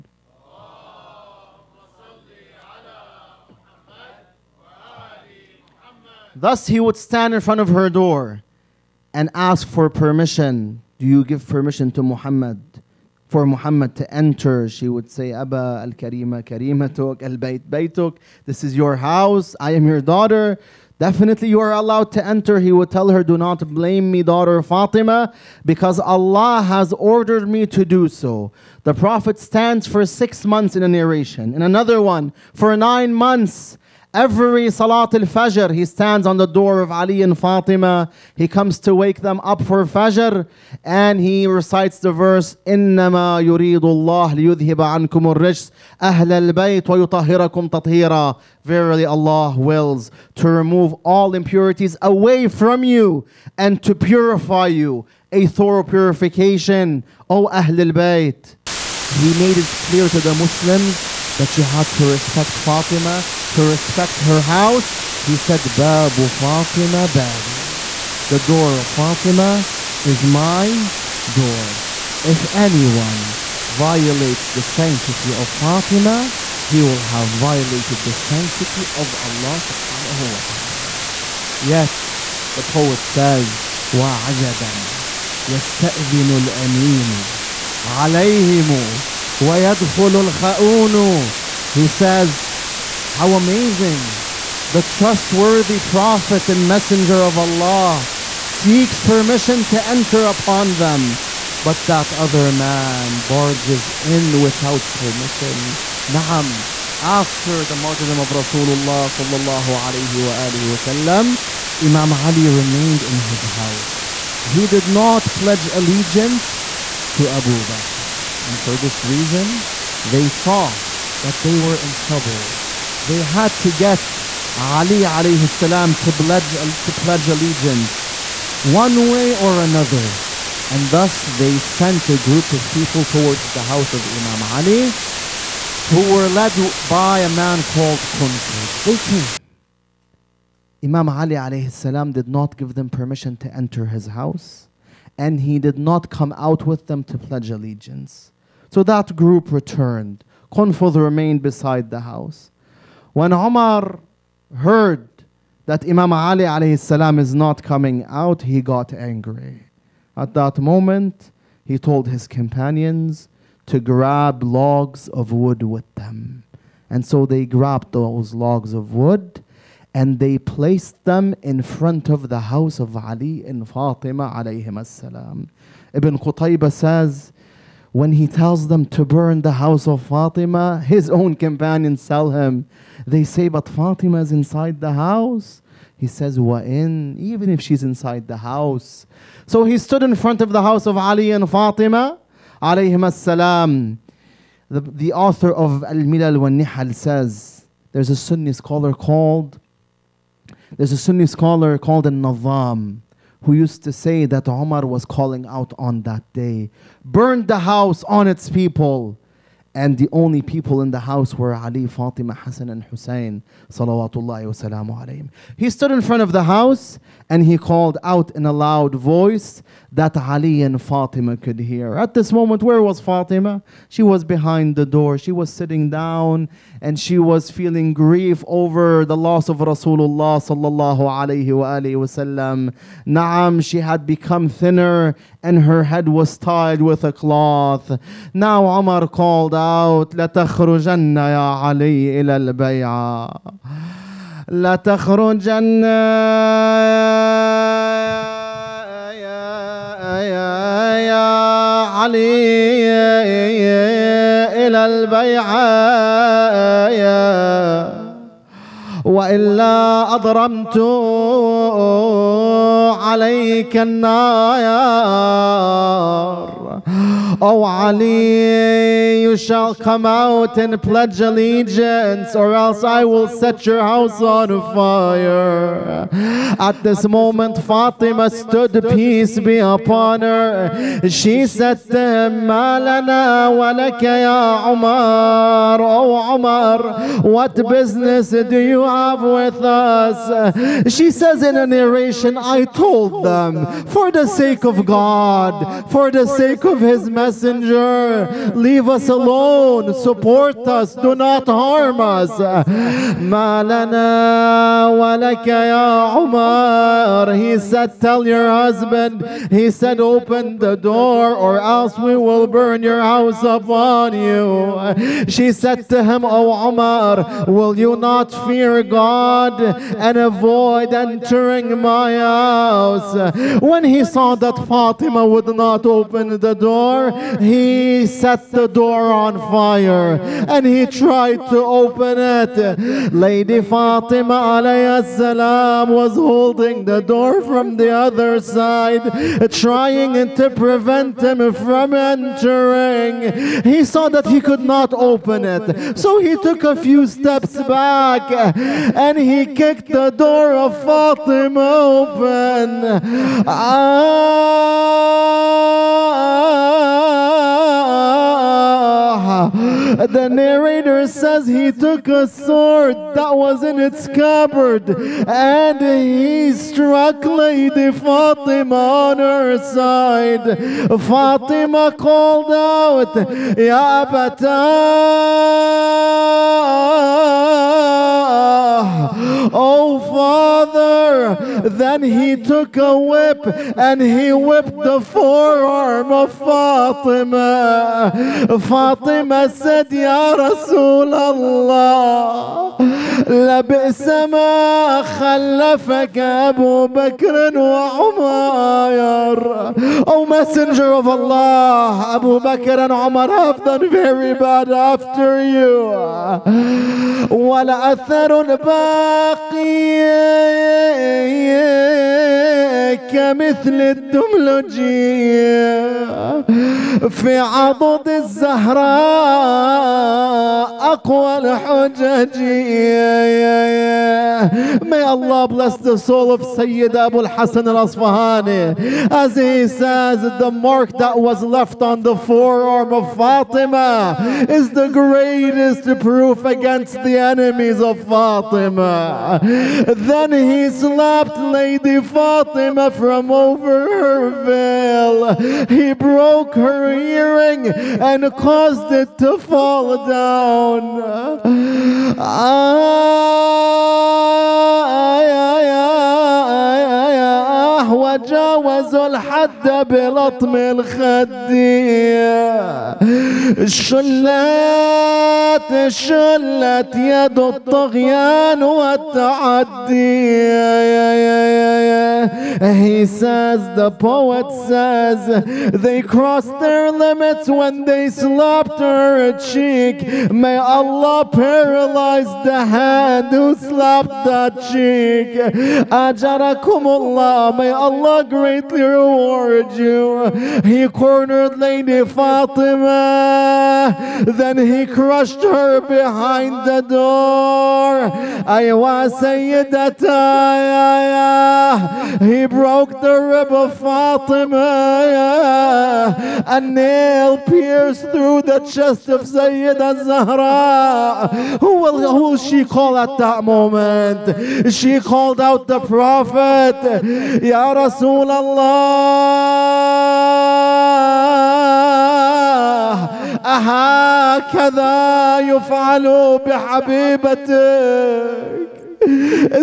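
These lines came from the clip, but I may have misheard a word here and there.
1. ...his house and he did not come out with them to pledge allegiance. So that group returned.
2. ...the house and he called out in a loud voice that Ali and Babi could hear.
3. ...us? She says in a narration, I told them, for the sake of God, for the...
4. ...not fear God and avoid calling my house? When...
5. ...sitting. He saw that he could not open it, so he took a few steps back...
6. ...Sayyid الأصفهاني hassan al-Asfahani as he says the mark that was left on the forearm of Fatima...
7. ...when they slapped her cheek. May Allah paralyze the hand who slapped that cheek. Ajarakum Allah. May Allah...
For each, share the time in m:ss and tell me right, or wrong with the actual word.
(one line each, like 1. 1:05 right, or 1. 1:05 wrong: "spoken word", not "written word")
1. 2:23 right
2. 3:36 wrong: "Fatima", not "Babi"
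3. 4:49 right
4. 5:17 wrong: "entering", not "calling"
5. 5:41 wrong: "entering", not "sitting"
6. 7:06 right
7. 7:57 right.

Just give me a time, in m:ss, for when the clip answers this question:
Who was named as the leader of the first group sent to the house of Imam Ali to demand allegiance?
2:18.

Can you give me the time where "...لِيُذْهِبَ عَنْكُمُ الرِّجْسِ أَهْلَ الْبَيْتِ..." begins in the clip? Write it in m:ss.
0:44.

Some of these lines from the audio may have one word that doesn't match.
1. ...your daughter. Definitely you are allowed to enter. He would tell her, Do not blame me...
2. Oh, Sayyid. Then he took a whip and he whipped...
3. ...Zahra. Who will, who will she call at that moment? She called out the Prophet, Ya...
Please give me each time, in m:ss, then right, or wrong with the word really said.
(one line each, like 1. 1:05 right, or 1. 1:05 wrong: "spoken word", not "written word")
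1. 0:19 right
2. 6:19 wrong: "Father", not "Sayyid"
3. 8:30 right.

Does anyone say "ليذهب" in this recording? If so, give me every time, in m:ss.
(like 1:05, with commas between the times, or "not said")
0:44.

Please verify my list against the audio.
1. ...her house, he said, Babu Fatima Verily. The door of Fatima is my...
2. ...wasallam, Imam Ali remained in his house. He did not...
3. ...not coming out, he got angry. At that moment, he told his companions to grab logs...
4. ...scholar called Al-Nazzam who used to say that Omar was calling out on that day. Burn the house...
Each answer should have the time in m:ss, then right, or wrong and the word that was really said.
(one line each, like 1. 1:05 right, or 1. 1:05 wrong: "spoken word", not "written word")
1. 1:04 wrong: "Babi", not "Verily"
2. 1:50 right
3. 2:37 right
4. 3:21 right.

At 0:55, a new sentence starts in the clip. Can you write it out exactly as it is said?
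A thorough purification, O Ahlul Bayt.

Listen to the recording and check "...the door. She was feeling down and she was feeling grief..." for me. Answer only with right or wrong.
wrong.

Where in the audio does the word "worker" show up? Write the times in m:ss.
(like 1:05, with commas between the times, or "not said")
not said.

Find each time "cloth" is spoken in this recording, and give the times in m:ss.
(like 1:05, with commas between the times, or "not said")
3:57.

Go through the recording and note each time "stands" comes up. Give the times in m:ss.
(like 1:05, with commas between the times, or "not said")
0:06, 0:29, 0:35.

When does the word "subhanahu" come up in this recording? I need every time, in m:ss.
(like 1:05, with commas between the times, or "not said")
1:19.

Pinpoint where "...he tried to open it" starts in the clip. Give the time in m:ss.
5:30.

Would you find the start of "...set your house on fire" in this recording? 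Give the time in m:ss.
4:33.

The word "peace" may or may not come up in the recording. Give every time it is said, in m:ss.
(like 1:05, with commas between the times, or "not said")
4:38.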